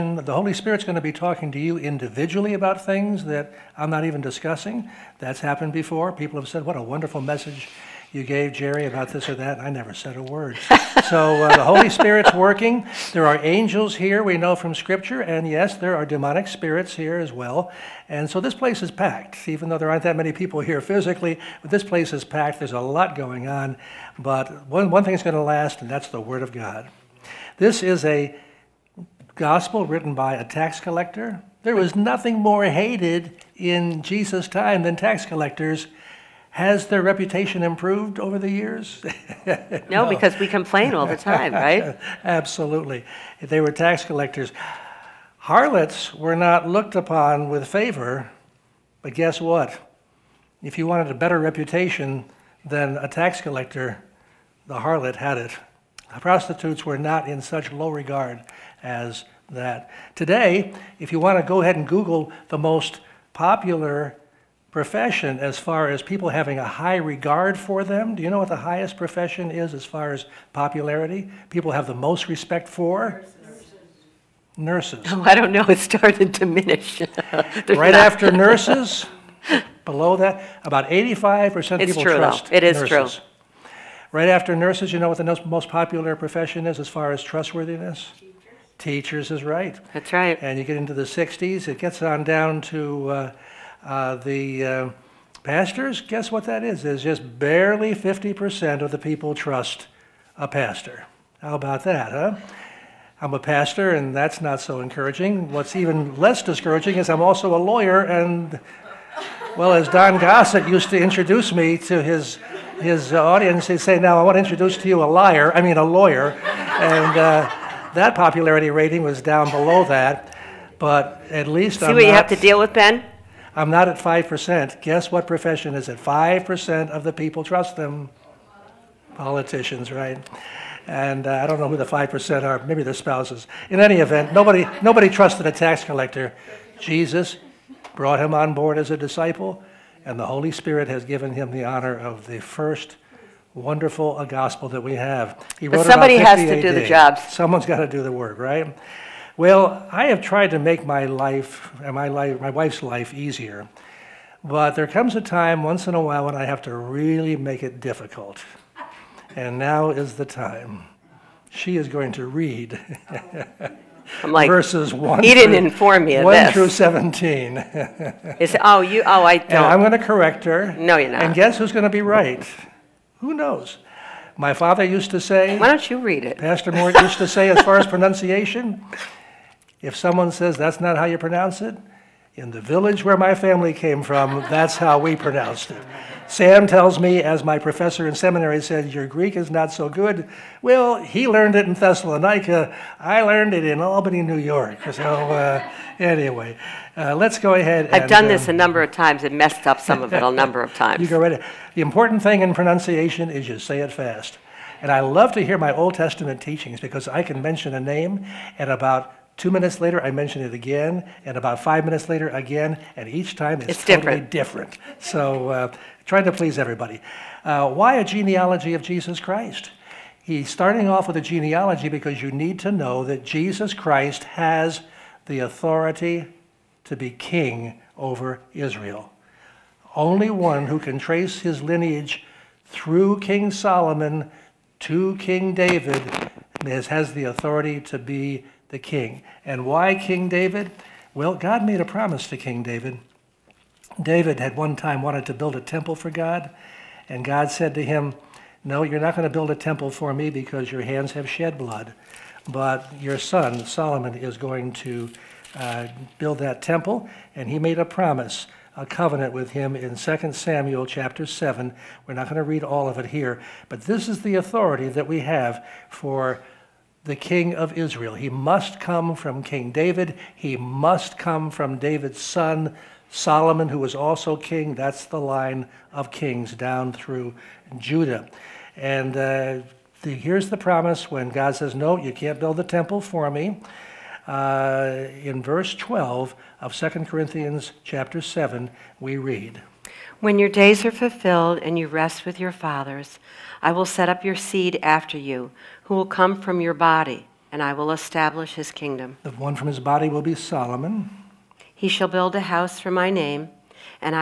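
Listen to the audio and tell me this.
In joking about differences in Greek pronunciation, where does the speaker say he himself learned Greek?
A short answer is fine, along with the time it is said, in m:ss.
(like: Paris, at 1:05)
Albany, New York, at 3:13.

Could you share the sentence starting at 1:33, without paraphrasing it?
Uh, uh, the uh, pastors, guess what that is?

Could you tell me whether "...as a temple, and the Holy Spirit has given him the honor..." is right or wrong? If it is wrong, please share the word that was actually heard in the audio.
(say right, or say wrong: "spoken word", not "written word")
wrong: "disciple", not "temple".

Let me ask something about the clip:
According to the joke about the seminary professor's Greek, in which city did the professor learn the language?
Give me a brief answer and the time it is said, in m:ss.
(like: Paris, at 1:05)
Thessalonica, at 3:11.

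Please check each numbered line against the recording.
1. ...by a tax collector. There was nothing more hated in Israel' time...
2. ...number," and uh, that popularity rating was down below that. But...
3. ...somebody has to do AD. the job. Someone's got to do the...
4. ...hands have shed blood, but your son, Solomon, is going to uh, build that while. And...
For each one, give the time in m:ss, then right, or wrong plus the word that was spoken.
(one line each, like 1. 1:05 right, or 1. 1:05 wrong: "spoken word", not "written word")
1. 0:30 wrong: "Jesus", not "Israel"
2. 1:55 wrong: "lawyer", not "number"
3. 2:25 right
4. 4:10 wrong: "temple", not "while".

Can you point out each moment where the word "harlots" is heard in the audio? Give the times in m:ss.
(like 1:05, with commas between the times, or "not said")
0:45, 0:54.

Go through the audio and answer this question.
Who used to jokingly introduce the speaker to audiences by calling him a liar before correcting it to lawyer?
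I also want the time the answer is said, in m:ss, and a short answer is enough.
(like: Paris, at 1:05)
Don Gossett, at 1:49.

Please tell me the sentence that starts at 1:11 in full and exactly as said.
People have the most respect for?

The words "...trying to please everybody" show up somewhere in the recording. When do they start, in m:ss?
3:36.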